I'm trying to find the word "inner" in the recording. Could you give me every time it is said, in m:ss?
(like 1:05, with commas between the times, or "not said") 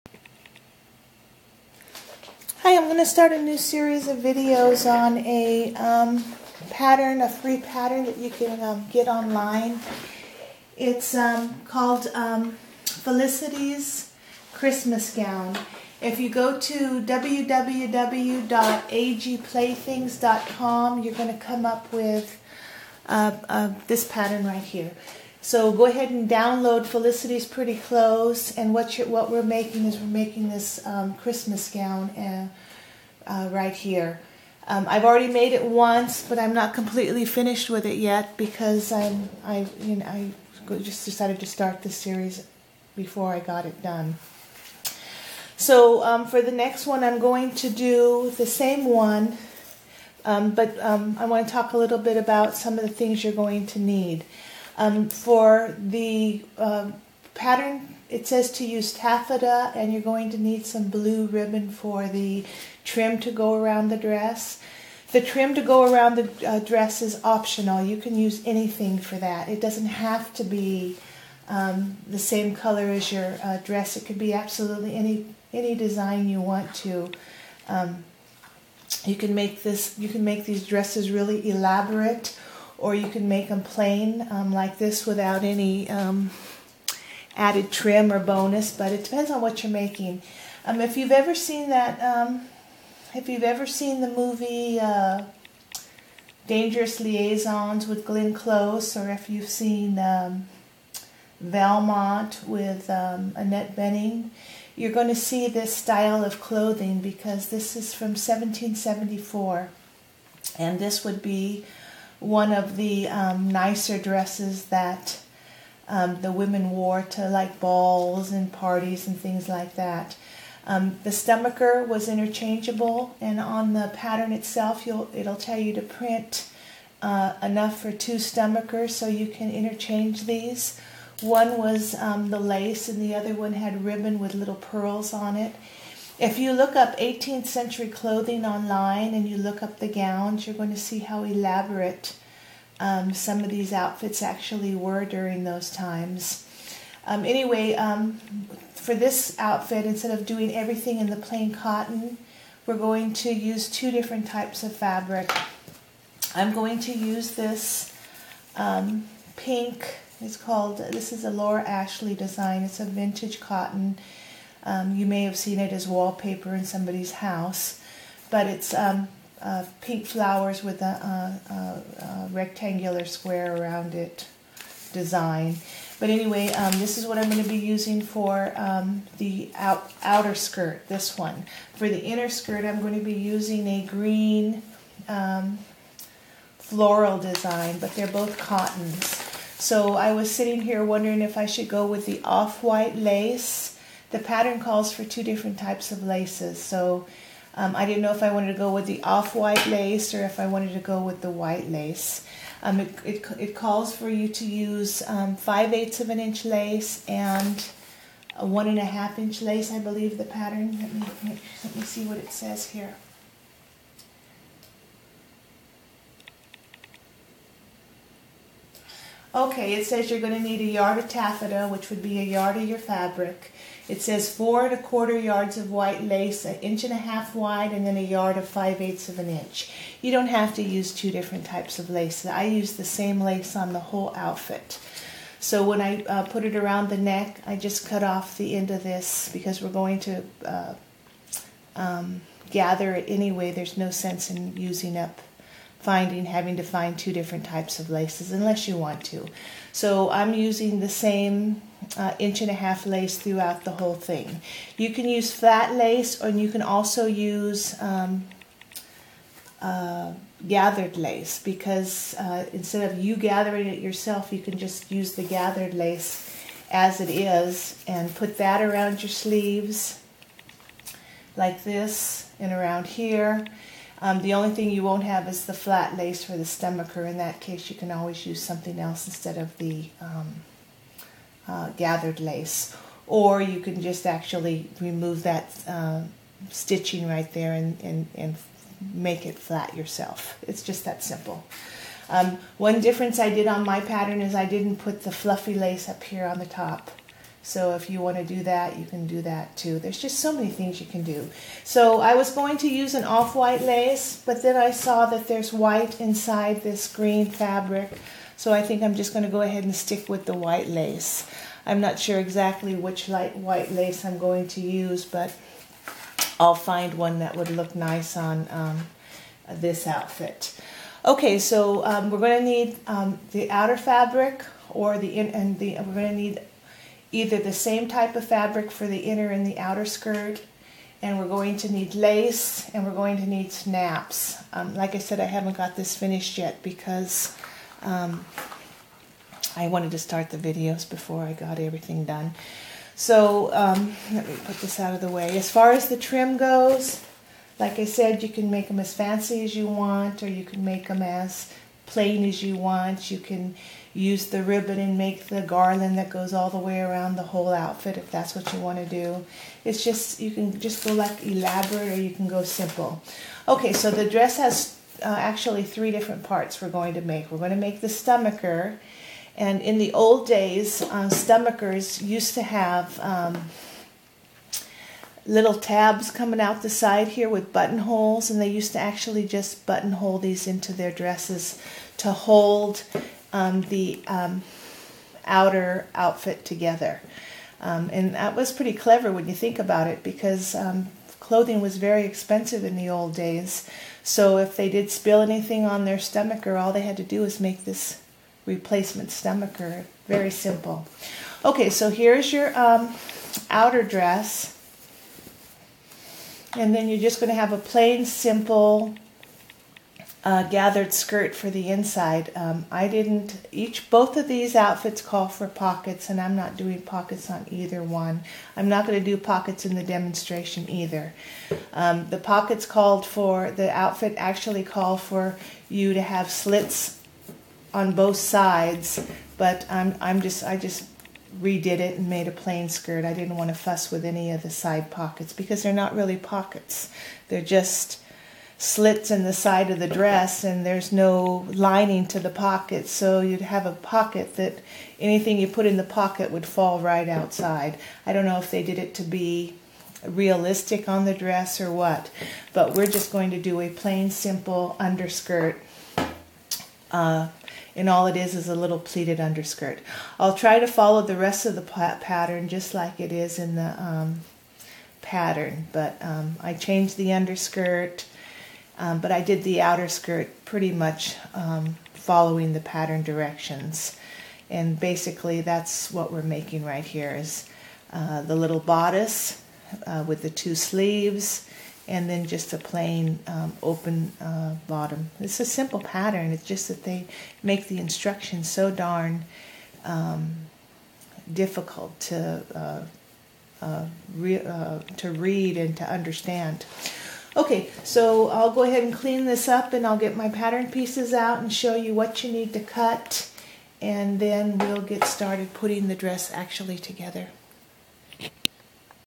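3:02, 5:28.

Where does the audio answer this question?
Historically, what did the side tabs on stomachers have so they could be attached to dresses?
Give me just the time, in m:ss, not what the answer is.
6:17.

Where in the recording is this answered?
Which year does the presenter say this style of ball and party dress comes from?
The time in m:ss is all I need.
1:48.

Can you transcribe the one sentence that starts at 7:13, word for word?
I didn't want to fuss with any of the side pockets because they're not really pockets.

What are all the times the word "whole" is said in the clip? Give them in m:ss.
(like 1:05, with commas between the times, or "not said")
3:53, 4:13, 5:57.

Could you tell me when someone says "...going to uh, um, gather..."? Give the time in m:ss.
3:59.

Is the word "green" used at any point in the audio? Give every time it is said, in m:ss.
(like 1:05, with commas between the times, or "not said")
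3:03, 5:06.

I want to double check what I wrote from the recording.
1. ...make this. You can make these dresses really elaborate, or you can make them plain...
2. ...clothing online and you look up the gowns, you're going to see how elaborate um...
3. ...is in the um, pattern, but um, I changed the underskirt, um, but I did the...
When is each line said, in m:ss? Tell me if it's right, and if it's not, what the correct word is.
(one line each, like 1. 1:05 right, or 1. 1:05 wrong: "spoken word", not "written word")
1. 1:19 right
2. 2:17 right
3. 7:43 right.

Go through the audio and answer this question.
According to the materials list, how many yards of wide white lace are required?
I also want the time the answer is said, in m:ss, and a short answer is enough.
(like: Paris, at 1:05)
4 1/4 yards, at 3:44.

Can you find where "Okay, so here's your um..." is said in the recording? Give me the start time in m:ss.
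6:41.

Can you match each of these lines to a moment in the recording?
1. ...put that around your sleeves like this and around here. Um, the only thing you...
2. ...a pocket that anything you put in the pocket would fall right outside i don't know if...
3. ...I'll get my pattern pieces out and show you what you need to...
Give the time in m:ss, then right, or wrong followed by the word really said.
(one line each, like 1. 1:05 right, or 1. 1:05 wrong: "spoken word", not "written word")
1. 4:28 right
2. 7:23 right
3. 8:19 right.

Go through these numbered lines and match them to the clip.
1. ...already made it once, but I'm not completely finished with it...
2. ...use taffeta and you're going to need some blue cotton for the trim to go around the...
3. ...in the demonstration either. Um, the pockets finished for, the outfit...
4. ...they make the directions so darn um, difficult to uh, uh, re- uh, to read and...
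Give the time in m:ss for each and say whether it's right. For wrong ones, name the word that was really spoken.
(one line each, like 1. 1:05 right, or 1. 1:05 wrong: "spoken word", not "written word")
1. 0:35 right
2. 0:58 wrong: "ribbon", not "cotton"
3. 6:59 wrong: "called", not "finished"
4. 8:06 wrong: "instructions", not "directions".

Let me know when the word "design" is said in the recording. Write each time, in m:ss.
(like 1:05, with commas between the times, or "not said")
1:15, 2:42, 2:54, 3:07.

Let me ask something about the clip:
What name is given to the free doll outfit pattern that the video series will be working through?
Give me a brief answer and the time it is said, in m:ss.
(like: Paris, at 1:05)
Felicity's Christmas Gown, at 0:12.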